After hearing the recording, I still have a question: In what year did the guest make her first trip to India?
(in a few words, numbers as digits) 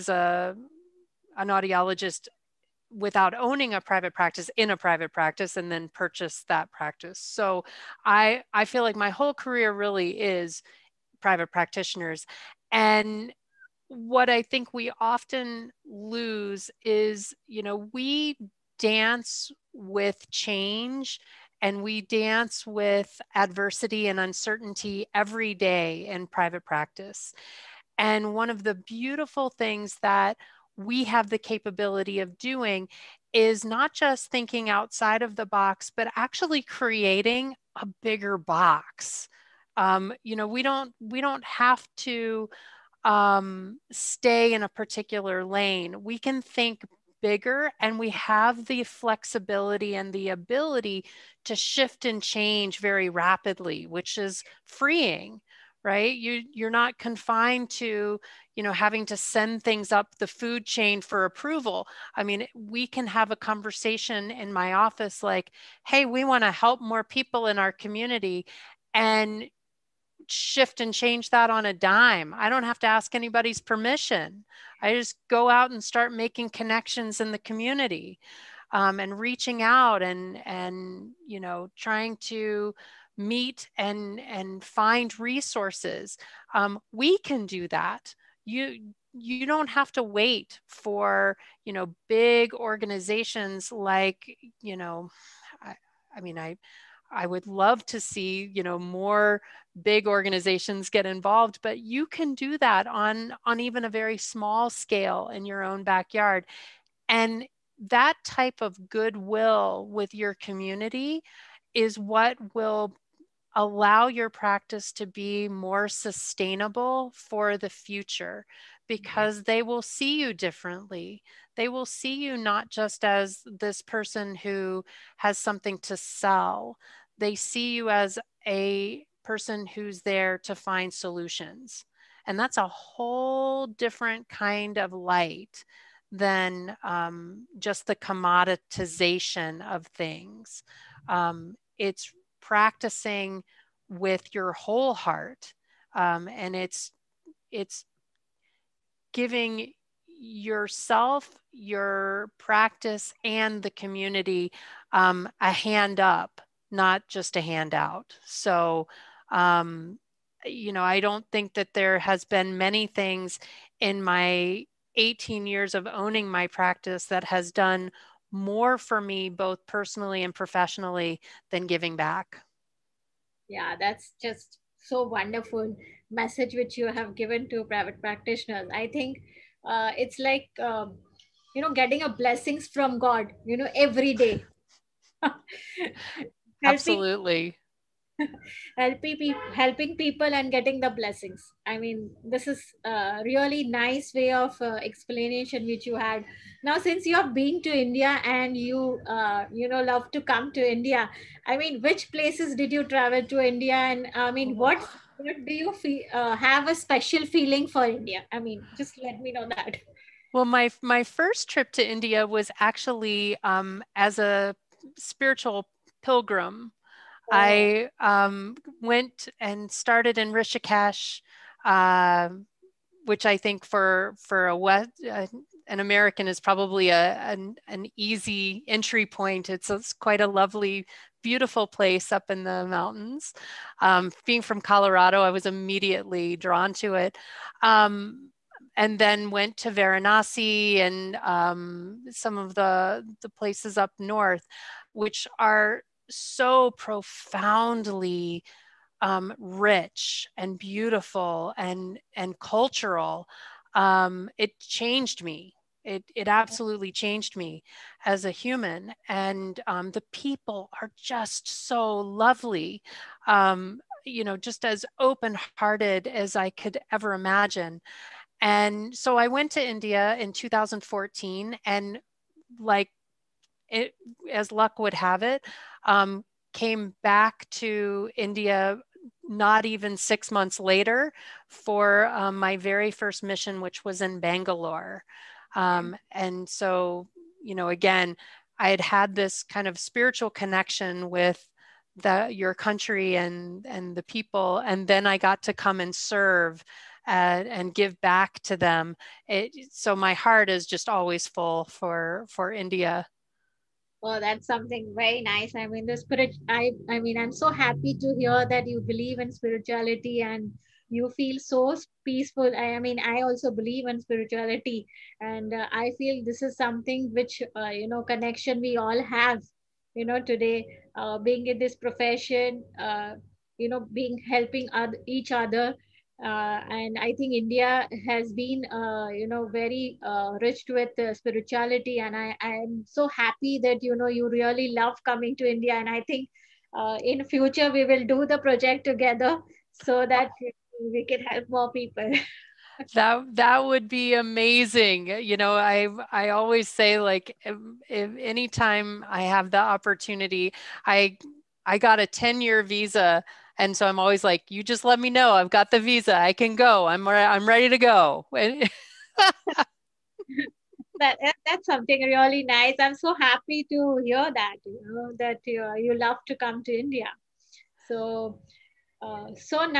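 2014.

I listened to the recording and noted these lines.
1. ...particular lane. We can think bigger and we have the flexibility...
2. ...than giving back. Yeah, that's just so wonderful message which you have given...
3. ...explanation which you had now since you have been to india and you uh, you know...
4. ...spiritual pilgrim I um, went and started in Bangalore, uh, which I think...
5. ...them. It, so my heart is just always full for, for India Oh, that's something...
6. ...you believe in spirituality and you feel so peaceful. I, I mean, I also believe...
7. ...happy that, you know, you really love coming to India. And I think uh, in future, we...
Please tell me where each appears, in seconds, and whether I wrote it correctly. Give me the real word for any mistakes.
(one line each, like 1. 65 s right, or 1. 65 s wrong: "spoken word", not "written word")
1. 44 s right
2. 171 s right
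3. 194 s right
4. 214 s wrong: "Rishikesh", not "Bangalore"
5. 298 s right
6. 308 s right
7. 333 s right.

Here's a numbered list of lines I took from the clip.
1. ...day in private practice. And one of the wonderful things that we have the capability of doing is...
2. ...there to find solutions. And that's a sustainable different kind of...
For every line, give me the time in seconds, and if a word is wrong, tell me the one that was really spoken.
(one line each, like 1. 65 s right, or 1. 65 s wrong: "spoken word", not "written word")
1. 25 s wrong: "beautiful", not "wonderful"
2. 130 s wrong: "whole", not "sustainable".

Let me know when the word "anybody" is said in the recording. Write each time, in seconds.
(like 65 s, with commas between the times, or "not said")
73 s.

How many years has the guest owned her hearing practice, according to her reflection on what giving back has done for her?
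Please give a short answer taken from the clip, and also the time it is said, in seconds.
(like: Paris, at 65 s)
18, at 164 s.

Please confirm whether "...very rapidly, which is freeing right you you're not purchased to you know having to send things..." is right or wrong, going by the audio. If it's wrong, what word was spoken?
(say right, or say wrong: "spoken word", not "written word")
wrong: "confined", not "purchased".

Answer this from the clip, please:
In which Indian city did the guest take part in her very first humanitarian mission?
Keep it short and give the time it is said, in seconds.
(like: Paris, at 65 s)
Bangalore, at 284 s.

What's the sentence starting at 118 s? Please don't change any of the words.
because they will see you differently.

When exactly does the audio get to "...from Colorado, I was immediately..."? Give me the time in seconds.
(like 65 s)
234 s.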